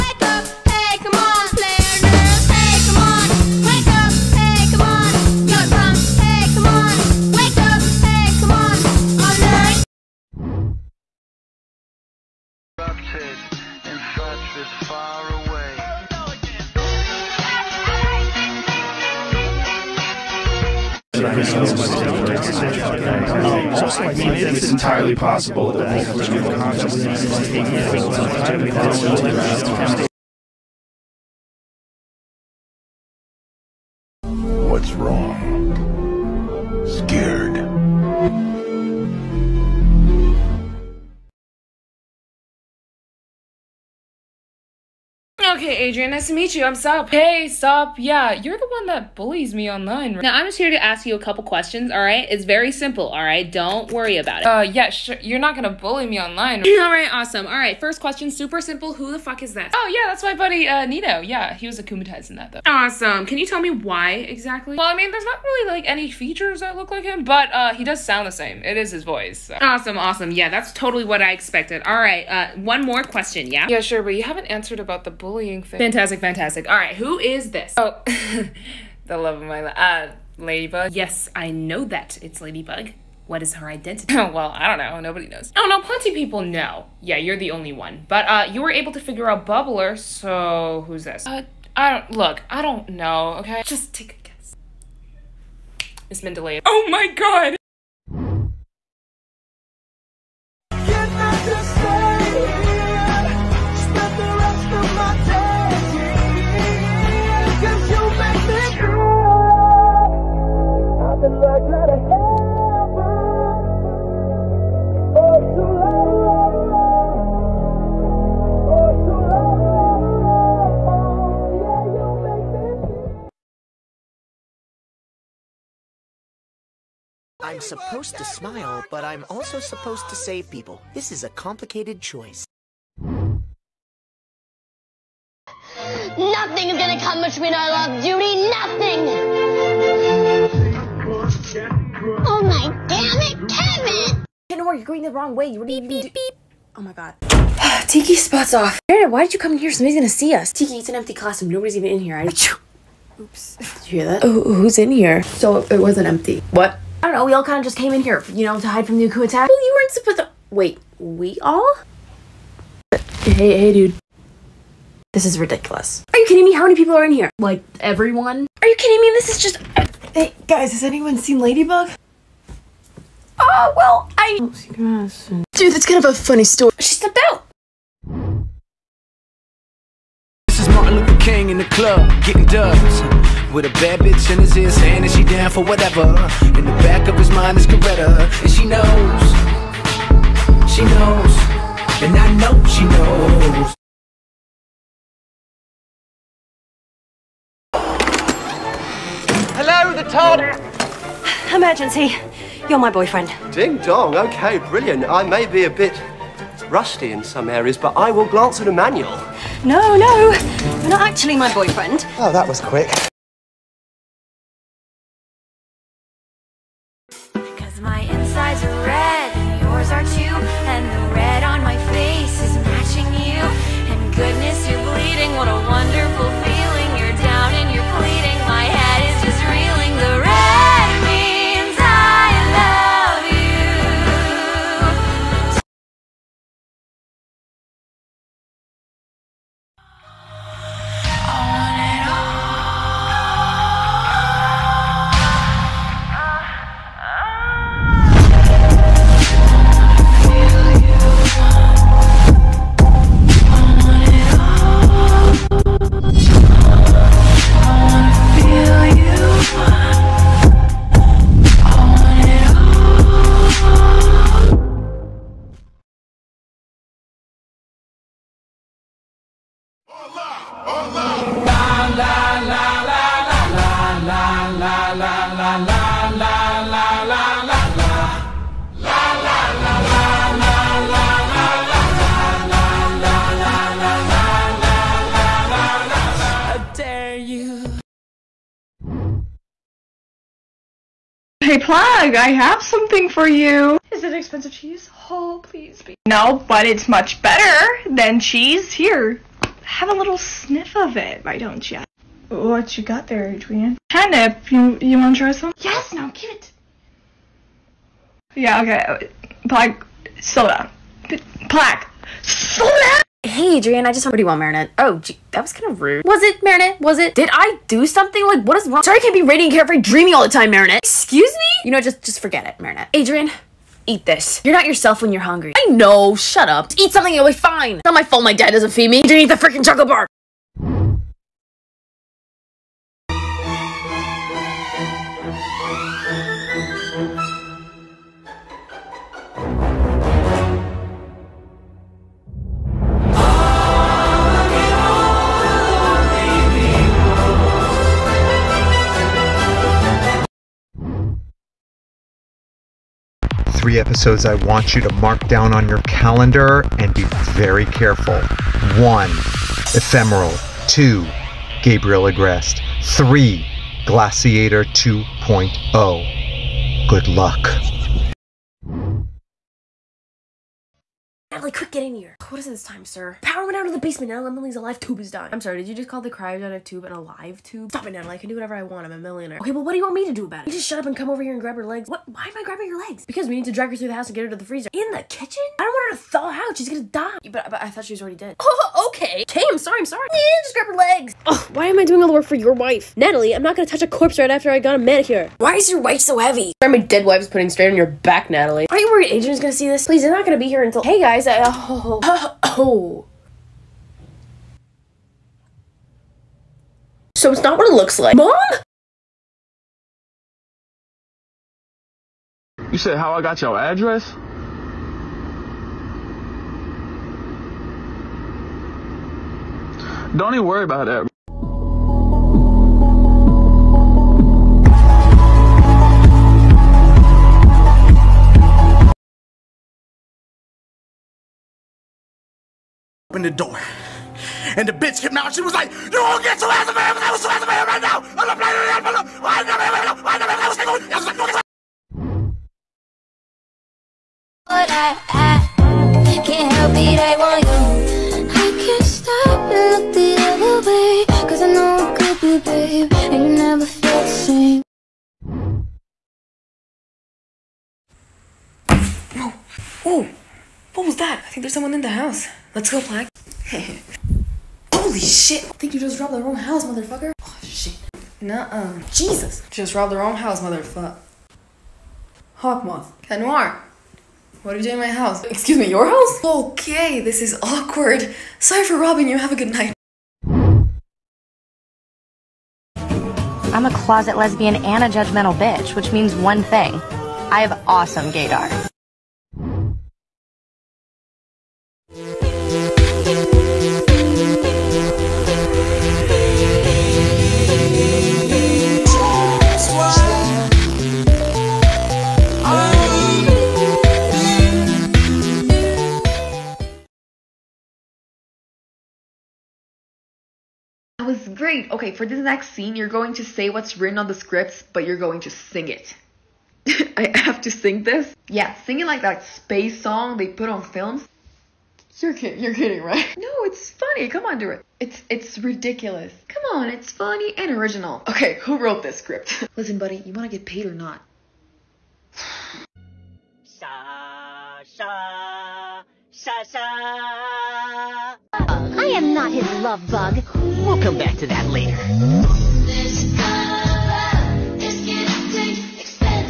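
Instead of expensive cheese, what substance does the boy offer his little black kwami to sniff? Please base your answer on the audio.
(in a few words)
Catnip.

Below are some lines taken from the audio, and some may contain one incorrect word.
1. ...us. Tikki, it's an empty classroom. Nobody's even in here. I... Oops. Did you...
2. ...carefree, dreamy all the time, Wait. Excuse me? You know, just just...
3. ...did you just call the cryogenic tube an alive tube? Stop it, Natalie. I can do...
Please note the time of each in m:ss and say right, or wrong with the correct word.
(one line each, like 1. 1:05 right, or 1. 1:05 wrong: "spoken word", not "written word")
1. 2:30 right
2. 5:19 wrong: "Marinette", not "Wait"
3. 6:15 right.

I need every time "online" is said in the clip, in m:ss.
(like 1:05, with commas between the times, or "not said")
0:49, 0:56.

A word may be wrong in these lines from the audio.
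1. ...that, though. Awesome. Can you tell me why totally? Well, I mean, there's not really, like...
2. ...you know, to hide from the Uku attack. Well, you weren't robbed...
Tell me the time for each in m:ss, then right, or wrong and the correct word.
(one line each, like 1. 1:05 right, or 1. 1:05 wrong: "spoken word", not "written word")
1. 1:02 wrong: "exactly", not "totally"
2. 2:38 wrong: "supposed", not "robbed".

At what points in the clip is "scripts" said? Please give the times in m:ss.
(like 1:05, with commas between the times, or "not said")
8:34, 8:48.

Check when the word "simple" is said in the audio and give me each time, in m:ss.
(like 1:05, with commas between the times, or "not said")
0:52, 0:58.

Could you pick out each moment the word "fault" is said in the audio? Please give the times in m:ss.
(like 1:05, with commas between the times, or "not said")
5:28.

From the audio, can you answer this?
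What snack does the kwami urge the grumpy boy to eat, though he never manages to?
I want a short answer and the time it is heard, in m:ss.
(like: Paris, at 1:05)
chocolate bar, at 5:29.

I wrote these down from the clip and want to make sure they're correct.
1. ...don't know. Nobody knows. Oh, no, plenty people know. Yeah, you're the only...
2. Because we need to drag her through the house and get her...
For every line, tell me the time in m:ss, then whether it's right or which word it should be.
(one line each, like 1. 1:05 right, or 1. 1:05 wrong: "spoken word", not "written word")
1. 1:24 right
2. 6:23 right.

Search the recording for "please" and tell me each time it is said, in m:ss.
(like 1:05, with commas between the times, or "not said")
4:55, 6:39.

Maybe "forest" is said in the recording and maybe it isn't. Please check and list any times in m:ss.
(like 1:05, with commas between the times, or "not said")
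not said.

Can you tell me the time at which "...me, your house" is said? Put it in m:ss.
7:55.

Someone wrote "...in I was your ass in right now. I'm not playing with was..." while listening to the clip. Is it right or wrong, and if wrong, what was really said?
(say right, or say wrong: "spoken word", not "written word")
right.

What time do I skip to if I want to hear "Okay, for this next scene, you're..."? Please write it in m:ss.
8:31.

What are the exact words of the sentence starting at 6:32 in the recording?
Natalie, I'm not gonna touch a corpse right after I got a manicure.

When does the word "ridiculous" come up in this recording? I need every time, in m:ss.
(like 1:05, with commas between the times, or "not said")
2:45, 8:45.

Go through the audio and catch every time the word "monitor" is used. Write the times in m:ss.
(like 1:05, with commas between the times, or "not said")
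not said.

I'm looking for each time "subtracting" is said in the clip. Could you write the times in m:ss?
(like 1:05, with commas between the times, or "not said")
not said.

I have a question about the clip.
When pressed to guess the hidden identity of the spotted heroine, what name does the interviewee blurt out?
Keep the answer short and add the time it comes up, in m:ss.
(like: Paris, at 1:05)
Miss Mendeley, at 1:36.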